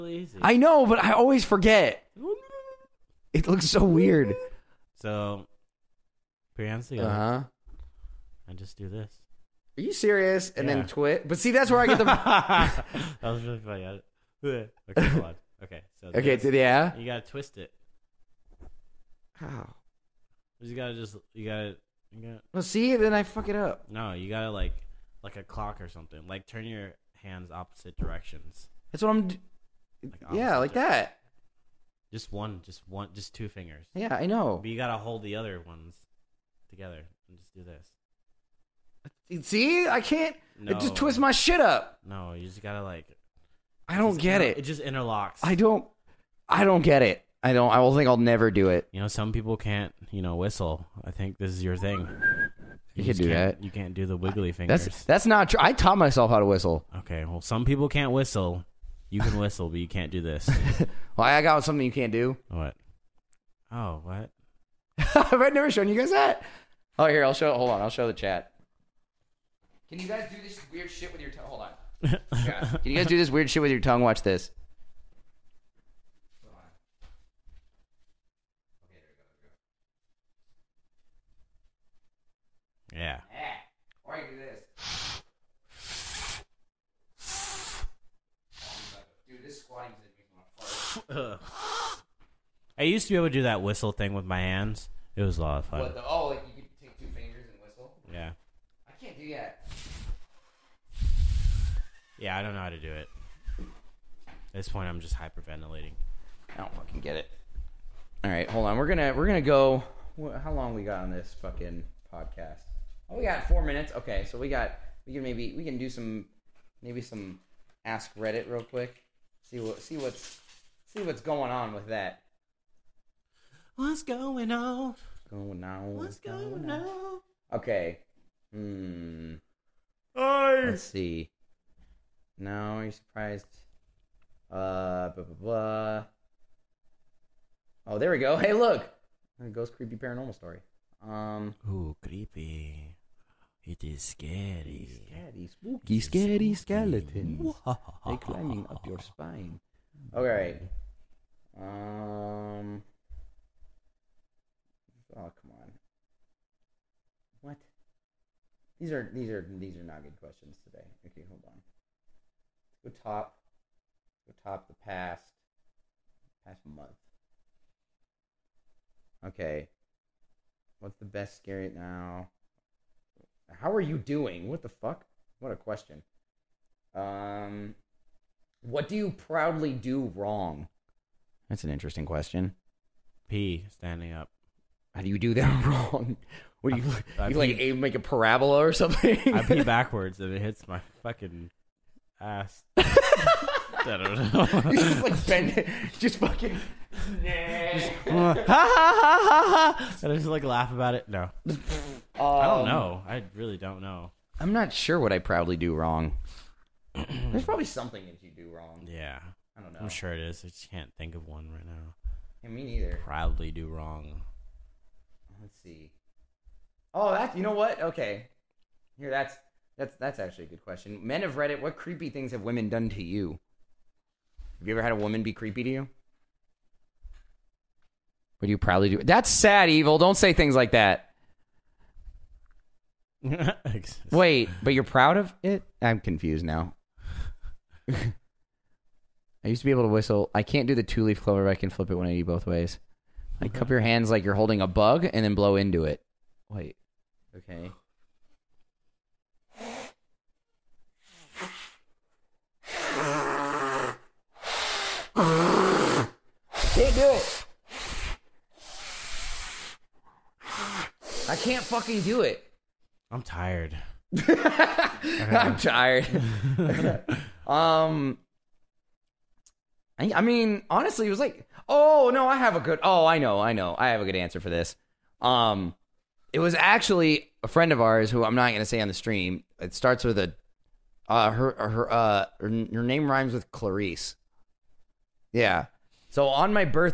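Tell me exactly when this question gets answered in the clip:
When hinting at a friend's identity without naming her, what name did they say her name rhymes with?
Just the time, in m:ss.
4:43.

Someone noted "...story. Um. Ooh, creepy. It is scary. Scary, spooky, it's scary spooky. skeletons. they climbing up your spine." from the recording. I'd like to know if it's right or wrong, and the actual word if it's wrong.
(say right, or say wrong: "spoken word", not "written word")
right.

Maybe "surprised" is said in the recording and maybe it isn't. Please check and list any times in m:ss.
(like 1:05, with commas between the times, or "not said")
2:12.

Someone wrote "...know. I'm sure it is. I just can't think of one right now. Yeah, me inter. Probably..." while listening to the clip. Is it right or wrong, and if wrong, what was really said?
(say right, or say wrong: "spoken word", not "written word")
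wrong: "neither", not "inter".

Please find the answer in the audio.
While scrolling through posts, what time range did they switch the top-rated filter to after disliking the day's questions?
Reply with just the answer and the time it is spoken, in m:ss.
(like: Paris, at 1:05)
Past month, at 2:46.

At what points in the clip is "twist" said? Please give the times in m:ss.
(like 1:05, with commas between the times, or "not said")
0:17, 0:40.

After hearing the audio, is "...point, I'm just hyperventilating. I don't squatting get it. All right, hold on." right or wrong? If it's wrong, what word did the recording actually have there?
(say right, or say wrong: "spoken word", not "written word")
wrong: "fucking", not "squatting".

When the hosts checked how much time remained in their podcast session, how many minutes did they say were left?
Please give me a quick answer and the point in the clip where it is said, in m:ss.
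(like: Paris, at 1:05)
4, at 1:53.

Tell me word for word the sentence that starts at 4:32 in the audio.
Oh, I know, I know, I have a good answer for this.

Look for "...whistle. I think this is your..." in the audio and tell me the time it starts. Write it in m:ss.
0:50.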